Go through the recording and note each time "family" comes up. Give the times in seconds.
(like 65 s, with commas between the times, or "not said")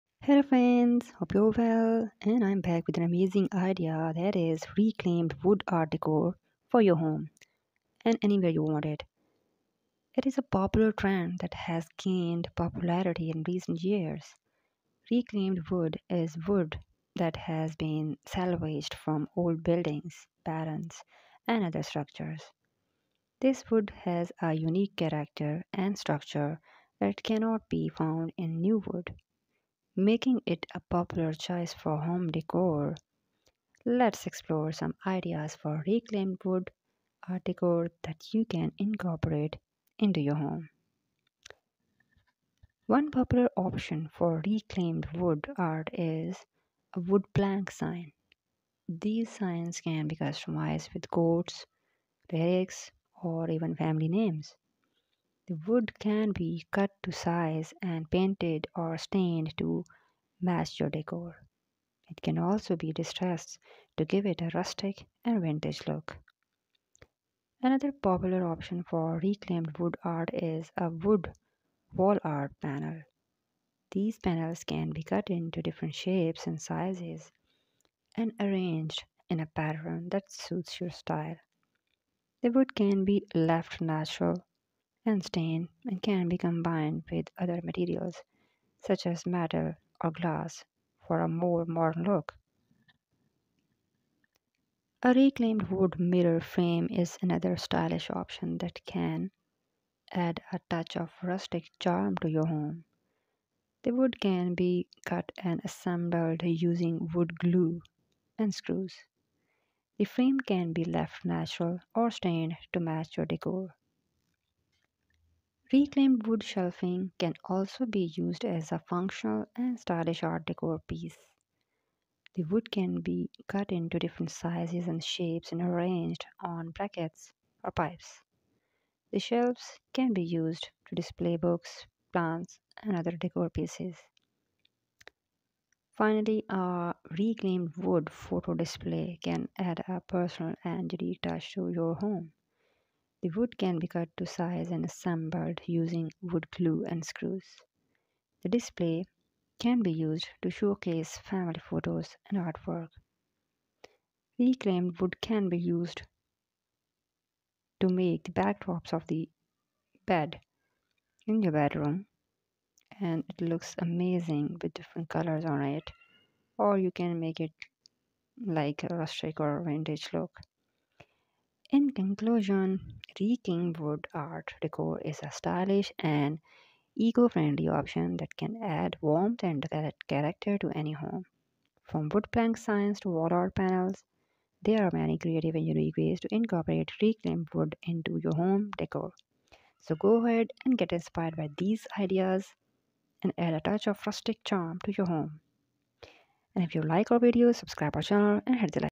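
53 s, 151 s.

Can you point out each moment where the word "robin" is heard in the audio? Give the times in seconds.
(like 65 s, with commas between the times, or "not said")
not said.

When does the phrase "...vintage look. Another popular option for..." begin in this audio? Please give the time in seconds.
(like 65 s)
65 s.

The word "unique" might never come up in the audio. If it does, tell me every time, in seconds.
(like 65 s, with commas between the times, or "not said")
24 s, 140 s, 185 s.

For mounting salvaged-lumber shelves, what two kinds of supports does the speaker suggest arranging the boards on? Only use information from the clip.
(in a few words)
Brackets or pipes.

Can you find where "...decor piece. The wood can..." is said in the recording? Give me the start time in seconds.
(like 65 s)
120 s.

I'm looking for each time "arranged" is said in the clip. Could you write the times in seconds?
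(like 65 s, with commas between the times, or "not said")
78 s, 125 s.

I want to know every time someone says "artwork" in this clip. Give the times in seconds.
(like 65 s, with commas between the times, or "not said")
152 s.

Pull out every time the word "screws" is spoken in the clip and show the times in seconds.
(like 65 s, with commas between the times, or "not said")
108 s, 147 s.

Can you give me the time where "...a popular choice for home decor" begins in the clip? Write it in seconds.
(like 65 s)
30 s.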